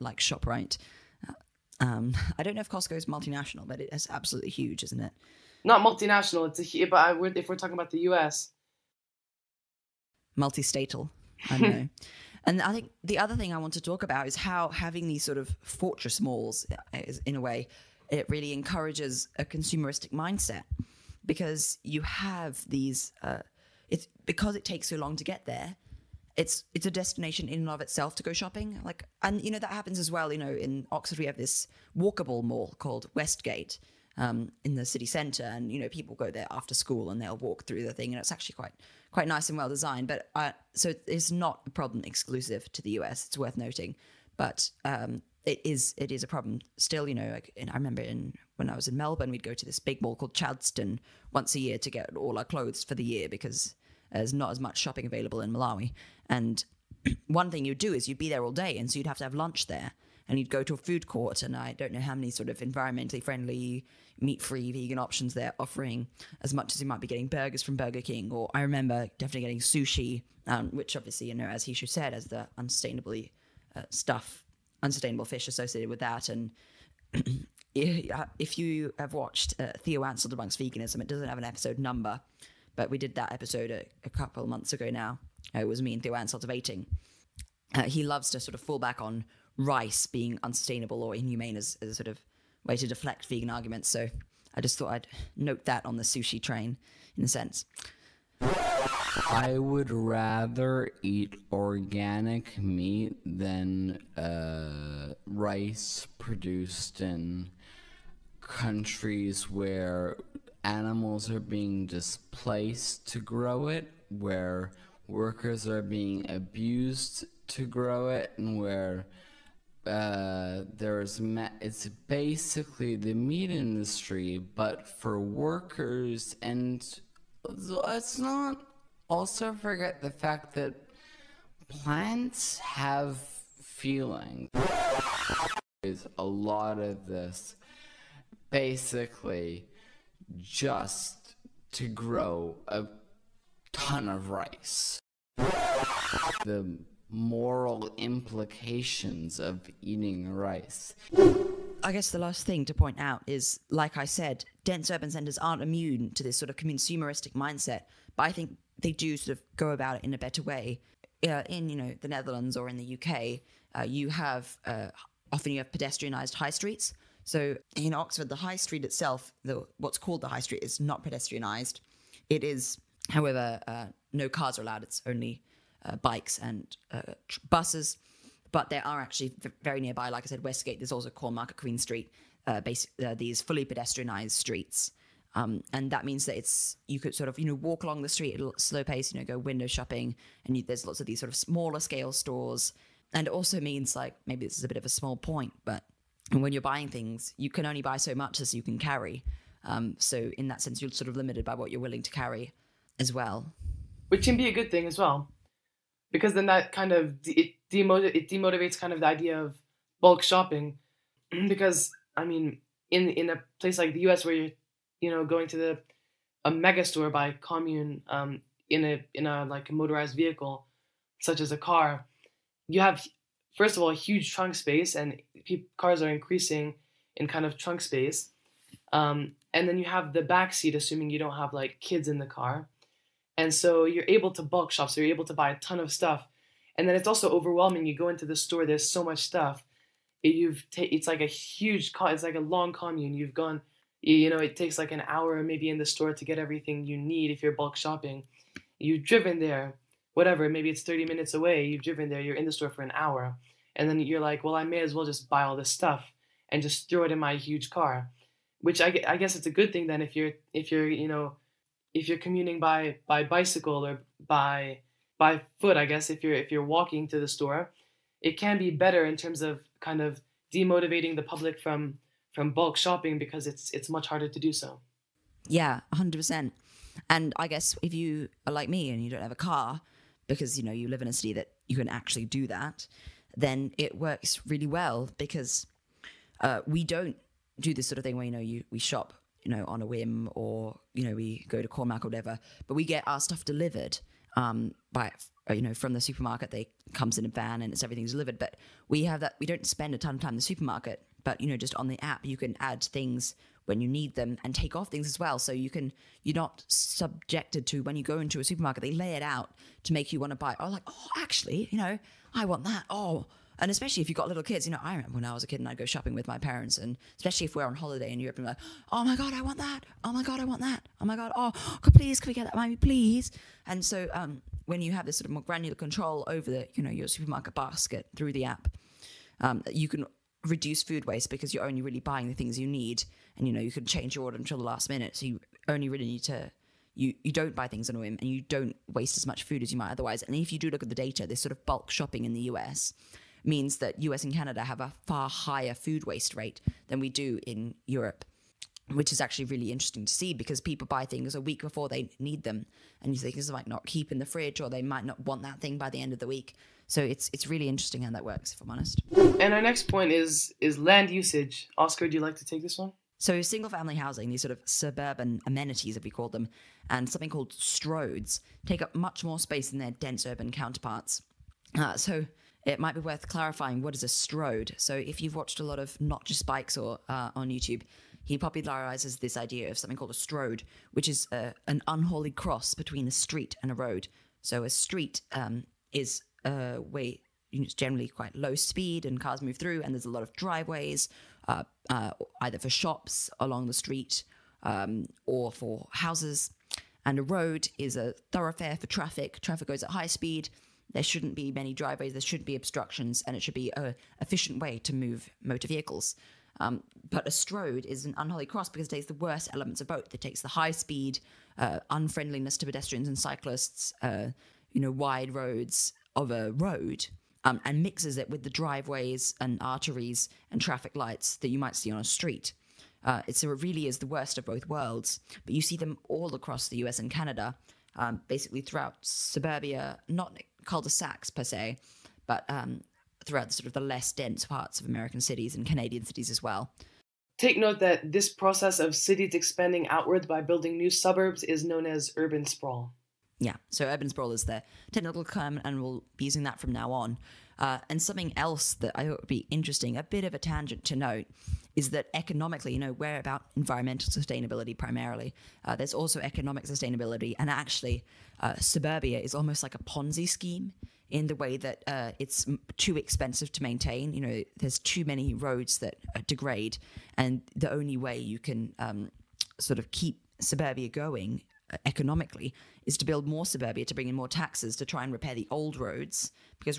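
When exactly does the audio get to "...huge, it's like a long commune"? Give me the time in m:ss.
4:01.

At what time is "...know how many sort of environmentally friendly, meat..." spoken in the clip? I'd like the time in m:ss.
1:01.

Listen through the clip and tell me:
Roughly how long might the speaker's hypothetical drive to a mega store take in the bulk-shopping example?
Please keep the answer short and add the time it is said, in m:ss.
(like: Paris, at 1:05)
30 minutes, at 4:10.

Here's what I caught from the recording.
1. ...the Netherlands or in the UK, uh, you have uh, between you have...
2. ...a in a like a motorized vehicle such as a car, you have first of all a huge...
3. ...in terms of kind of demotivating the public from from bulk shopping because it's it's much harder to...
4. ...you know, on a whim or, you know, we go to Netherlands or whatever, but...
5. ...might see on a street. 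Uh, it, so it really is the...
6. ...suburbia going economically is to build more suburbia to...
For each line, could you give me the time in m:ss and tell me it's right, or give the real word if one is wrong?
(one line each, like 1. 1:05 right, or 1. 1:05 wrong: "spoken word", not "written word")
1. 2:42 wrong: "often", not "between"
2. 3:38 right
3. 4:29 right
4. 4:49 wrong: "Cormac", not "Netherlands"
5. 7:01 right
6. 7:50 right.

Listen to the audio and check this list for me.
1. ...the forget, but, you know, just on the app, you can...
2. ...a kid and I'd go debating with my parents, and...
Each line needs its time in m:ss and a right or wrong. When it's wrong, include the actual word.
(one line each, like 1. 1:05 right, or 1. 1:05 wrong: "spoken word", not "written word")
1. 5:00 wrong: "supermarket", not "forget"
2. 5:15 wrong: "shopping", not "debating".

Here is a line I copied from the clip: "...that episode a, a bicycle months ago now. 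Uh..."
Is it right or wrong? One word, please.
wrong.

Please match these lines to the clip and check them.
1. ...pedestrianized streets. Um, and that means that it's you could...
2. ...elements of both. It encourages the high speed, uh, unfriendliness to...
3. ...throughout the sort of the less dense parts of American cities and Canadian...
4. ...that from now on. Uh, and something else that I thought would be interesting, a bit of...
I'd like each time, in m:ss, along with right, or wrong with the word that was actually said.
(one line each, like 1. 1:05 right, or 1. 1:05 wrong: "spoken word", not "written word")
1. 3:03 right
2. 6:49 wrong: "takes", not "encourages"
3. 7:13 right
4. 7:26 right.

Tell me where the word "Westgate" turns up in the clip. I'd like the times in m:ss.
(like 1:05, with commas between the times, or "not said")
0:33, 3:00.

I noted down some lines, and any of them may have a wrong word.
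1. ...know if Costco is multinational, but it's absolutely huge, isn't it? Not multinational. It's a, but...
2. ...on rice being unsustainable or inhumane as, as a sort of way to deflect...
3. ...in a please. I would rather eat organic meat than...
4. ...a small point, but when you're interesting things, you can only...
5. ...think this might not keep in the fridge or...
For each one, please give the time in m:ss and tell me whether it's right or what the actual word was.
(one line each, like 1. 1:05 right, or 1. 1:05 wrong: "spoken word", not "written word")
1. 0:02 right
2. 1:29 right
3. 1:37 wrong: "sense", not "please"
4. 3:14 wrong: "buying", not "interesting"
5. 5:53 right.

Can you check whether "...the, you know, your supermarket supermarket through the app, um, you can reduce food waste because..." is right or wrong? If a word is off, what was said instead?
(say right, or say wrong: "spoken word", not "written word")
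wrong: "basket", not "supermarket".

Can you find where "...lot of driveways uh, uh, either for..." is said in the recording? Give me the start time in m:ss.
6:30.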